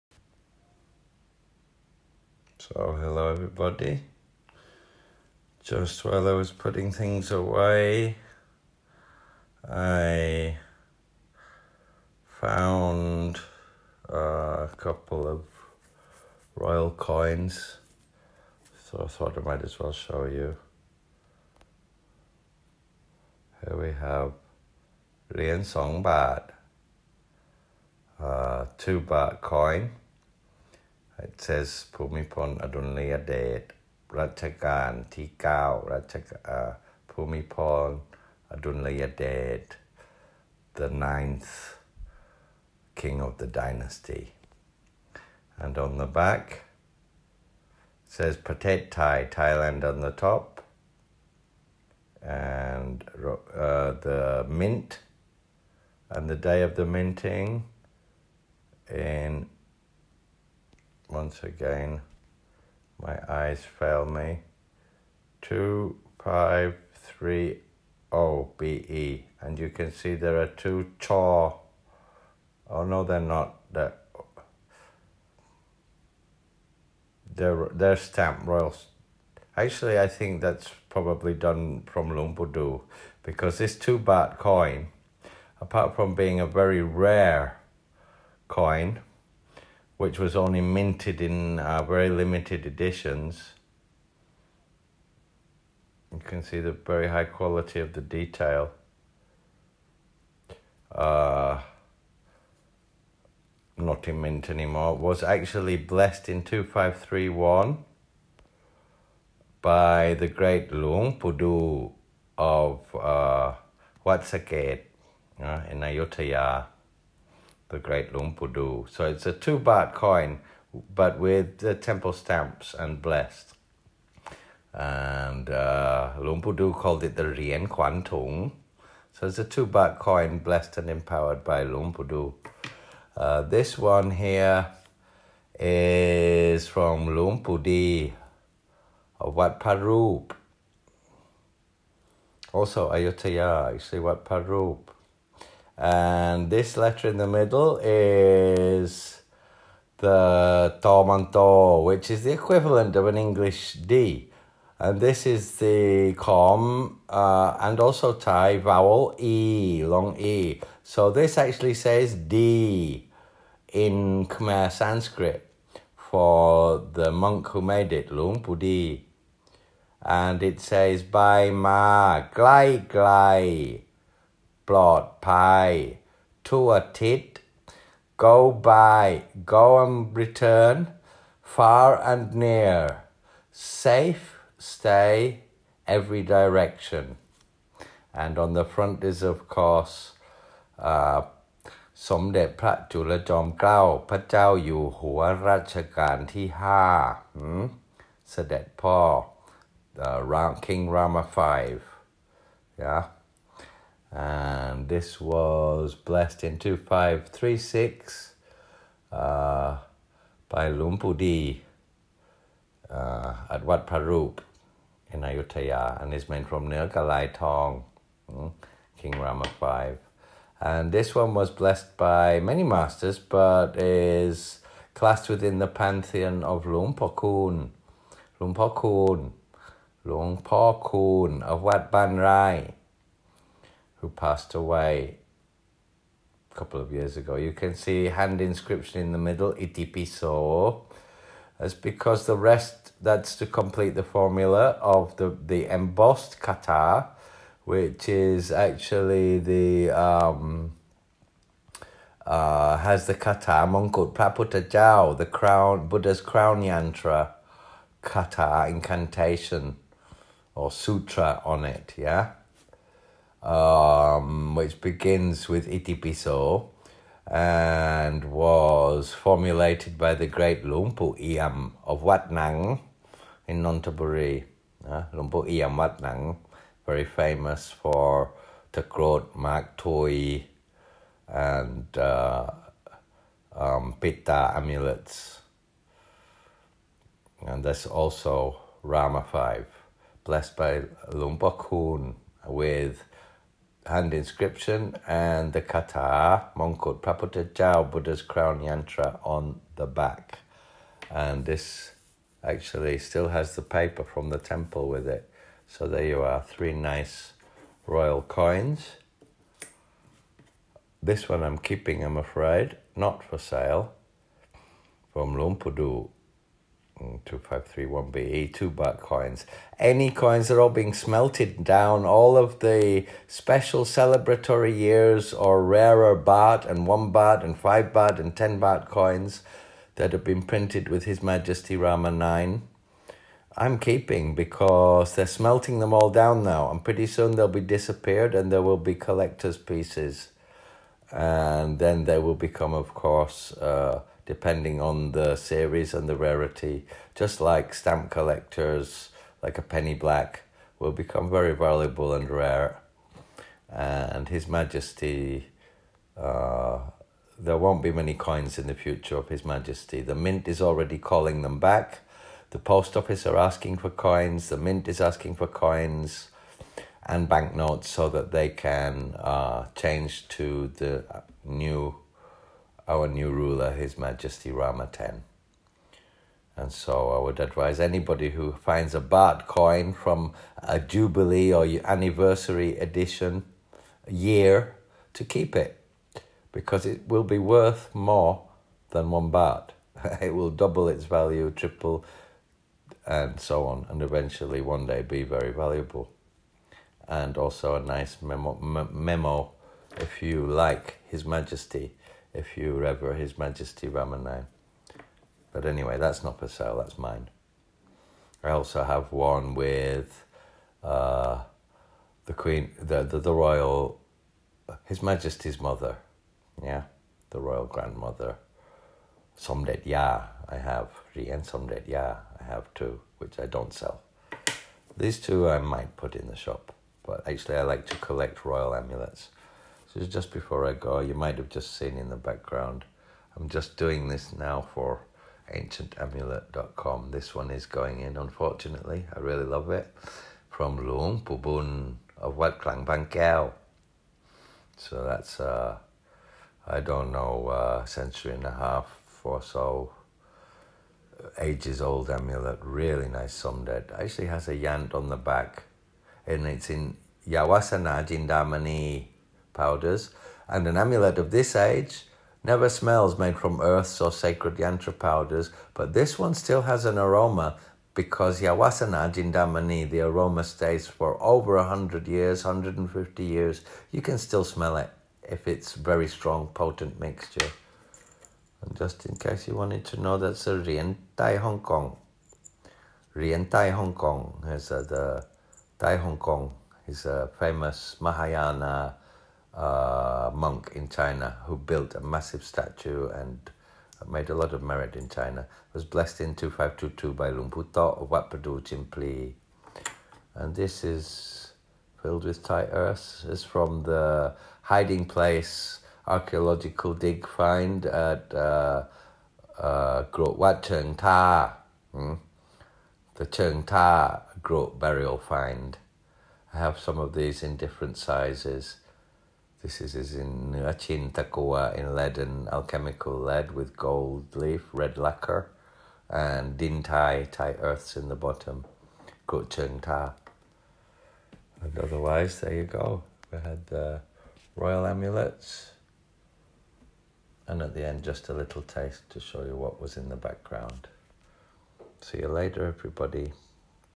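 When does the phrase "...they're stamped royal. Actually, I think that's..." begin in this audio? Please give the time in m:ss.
1:17.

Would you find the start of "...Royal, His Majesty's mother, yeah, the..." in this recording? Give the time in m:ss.
6:53.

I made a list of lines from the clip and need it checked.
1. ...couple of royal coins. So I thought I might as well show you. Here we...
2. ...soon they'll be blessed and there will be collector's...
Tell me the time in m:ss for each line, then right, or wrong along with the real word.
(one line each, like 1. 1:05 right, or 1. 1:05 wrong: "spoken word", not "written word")
1. 0:14 right
2. 5:37 wrong: "disappeared", not "blessed".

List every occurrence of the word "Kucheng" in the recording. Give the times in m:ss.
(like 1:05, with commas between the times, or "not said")
8:49.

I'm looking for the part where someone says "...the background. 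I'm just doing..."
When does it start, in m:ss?
7:12.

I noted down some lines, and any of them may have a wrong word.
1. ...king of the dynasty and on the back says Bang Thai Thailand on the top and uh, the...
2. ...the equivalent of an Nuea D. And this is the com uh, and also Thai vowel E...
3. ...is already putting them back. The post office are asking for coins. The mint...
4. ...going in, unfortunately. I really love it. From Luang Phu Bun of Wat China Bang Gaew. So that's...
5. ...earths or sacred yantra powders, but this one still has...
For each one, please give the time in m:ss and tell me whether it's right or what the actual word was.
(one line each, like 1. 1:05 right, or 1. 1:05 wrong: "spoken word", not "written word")
1. 0:43 wrong: "Patet", not "Bang"
2. 2:32 wrong: "English", not "Nuea"
3. 6:00 wrong: "calling", not "putting"
4. 7:17 wrong: "Klang", not "China"
5. 7:43 right.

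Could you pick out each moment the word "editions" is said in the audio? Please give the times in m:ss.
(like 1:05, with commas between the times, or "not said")
1:32, 6:22.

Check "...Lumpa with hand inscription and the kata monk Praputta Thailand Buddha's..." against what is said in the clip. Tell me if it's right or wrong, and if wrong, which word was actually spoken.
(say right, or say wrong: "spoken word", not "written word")
wrong: "Jao", not "Thailand".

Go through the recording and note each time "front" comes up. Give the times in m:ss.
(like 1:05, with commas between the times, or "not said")
3:08.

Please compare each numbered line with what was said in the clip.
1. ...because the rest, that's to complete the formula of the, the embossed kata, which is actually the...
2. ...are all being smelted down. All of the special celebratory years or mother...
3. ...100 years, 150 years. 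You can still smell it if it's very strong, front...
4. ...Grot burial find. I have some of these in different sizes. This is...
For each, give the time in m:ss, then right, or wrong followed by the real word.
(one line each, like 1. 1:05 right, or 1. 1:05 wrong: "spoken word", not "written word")
1. 4:01 right
2. 5:20 wrong: "rarer", not "mother"
3. 7:51 wrong: "potent", not "front"
4. 8:34 right.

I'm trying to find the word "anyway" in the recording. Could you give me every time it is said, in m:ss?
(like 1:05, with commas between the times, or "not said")
6:45.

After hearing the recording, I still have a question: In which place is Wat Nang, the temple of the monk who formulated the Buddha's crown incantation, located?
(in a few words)
Nonthaburi.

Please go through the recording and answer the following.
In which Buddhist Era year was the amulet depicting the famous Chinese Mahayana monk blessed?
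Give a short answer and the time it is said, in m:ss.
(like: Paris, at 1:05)
2522, at 8:16.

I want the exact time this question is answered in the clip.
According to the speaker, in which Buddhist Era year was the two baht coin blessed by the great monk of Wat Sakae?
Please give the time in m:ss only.
1:46.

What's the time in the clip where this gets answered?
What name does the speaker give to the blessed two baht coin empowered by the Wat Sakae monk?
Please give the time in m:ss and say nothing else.
2:07.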